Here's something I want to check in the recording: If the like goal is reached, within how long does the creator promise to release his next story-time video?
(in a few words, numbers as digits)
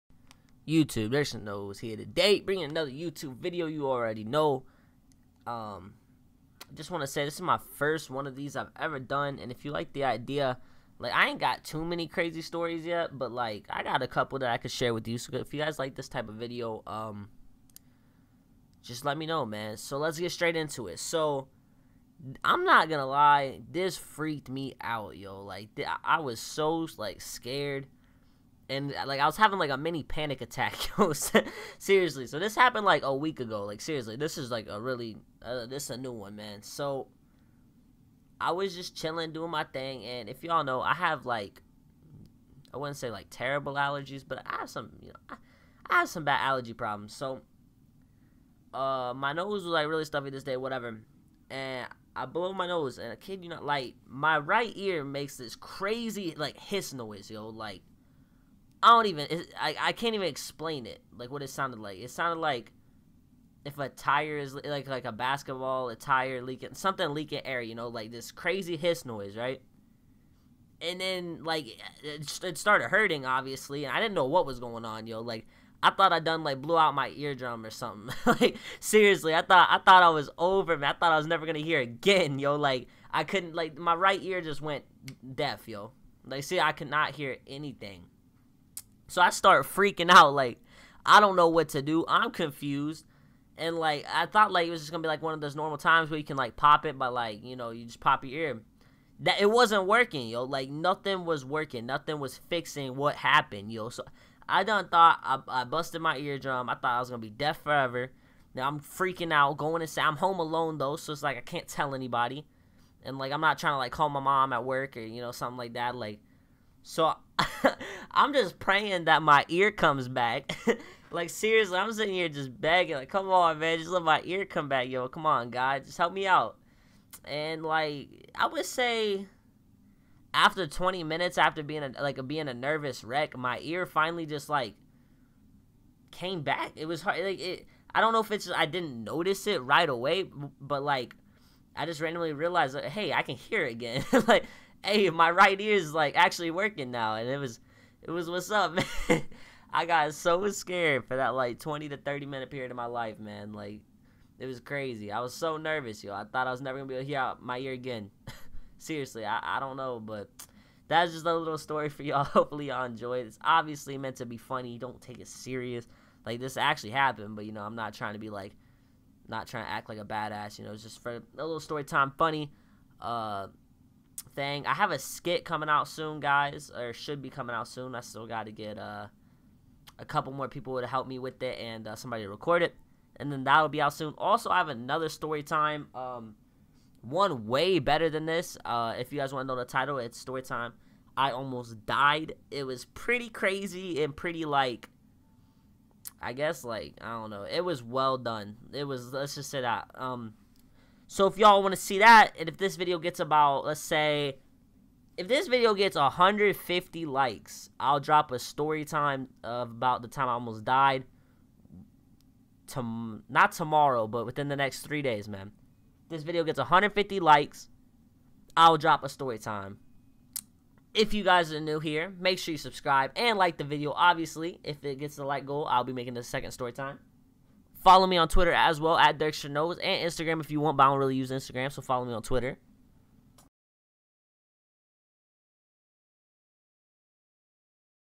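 3 days.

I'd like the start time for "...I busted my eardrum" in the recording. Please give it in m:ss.
1:45.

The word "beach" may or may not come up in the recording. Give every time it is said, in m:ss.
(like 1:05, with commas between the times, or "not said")
not said.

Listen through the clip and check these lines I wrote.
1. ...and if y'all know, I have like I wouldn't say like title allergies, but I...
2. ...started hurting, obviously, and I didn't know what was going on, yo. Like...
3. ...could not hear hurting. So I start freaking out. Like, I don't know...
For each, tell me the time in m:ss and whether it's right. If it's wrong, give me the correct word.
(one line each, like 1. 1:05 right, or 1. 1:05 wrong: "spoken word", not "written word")
1. 0:40 wrong: "terrible", not "title"
2. 1:12 right
3. 1:26 wrong: "anything", not "hurting".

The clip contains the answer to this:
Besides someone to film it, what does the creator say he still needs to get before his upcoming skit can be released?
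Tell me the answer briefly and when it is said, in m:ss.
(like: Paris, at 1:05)
A couple more people, at 2:59.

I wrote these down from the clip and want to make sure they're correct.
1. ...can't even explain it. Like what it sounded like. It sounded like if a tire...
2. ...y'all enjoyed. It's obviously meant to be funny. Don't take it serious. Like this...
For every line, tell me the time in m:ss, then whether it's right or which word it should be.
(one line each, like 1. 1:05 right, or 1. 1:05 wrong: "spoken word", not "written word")
1. 0:59 right
2. 2:42 right.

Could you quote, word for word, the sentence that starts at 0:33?
Like seriously, this is like a really uh, this is a new one, man.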